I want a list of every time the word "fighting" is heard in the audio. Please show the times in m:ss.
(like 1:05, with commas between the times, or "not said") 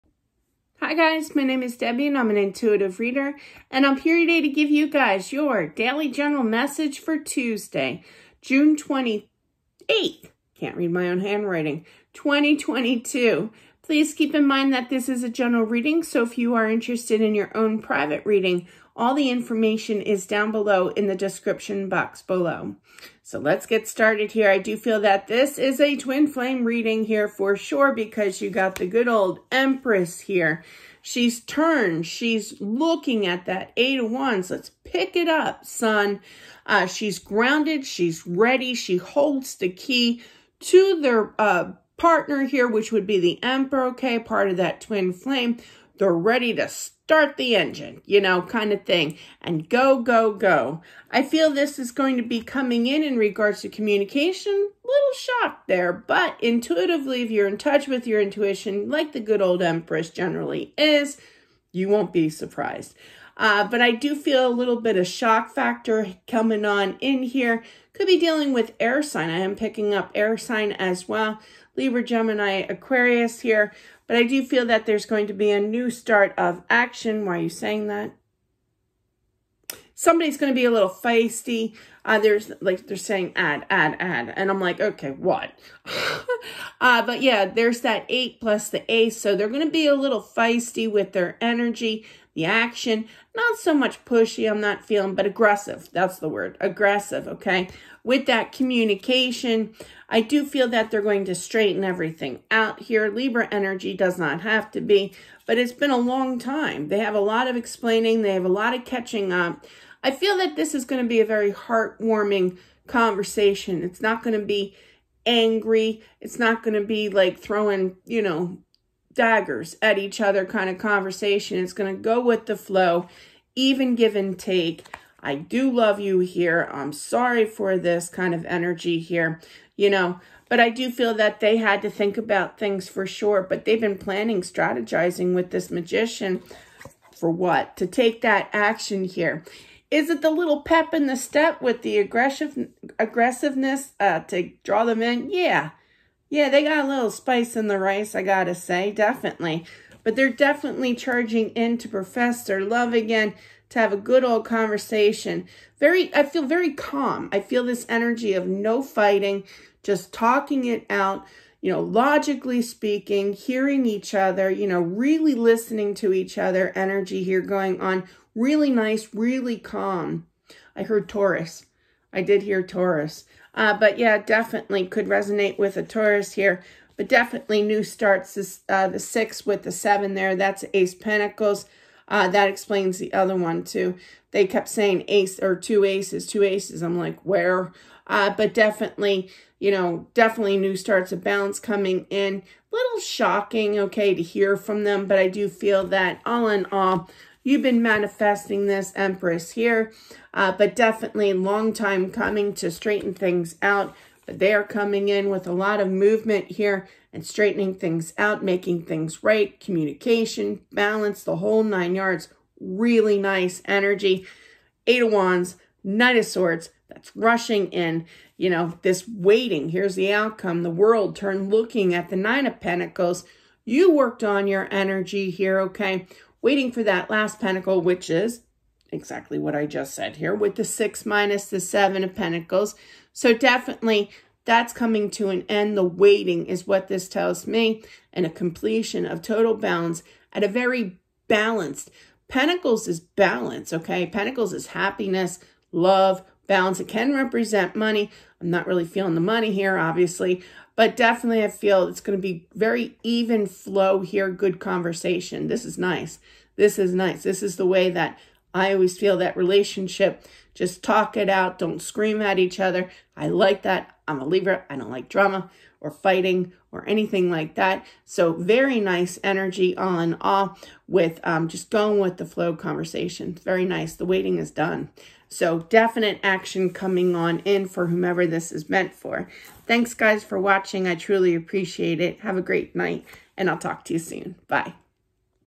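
2:38, 4:25.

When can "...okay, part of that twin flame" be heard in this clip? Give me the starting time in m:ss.
0:43.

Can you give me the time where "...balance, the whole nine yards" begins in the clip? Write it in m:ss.
3:30.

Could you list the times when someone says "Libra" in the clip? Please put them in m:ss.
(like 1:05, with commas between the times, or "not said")
1:11, 1:43, 4:24.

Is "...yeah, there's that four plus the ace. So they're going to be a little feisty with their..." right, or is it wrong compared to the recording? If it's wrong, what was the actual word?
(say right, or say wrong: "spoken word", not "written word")
wrong: "eight", not "four".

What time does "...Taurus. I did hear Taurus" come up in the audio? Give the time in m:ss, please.
2:51.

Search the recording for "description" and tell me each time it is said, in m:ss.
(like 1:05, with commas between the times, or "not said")
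0:21.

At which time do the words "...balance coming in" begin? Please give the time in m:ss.
3:11.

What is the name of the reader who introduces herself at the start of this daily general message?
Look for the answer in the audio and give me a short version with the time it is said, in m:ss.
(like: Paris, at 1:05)
Debbie, at 0:01.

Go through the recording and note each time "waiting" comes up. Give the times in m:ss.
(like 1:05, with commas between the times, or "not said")
3:39, 3:46, 3:55, 4:34.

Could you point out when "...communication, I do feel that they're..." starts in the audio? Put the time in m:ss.
1:38.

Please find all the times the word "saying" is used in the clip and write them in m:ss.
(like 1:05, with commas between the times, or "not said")
1:17, 1:22, 3:04.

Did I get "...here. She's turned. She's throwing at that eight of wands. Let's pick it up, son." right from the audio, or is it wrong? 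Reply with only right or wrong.
wrong.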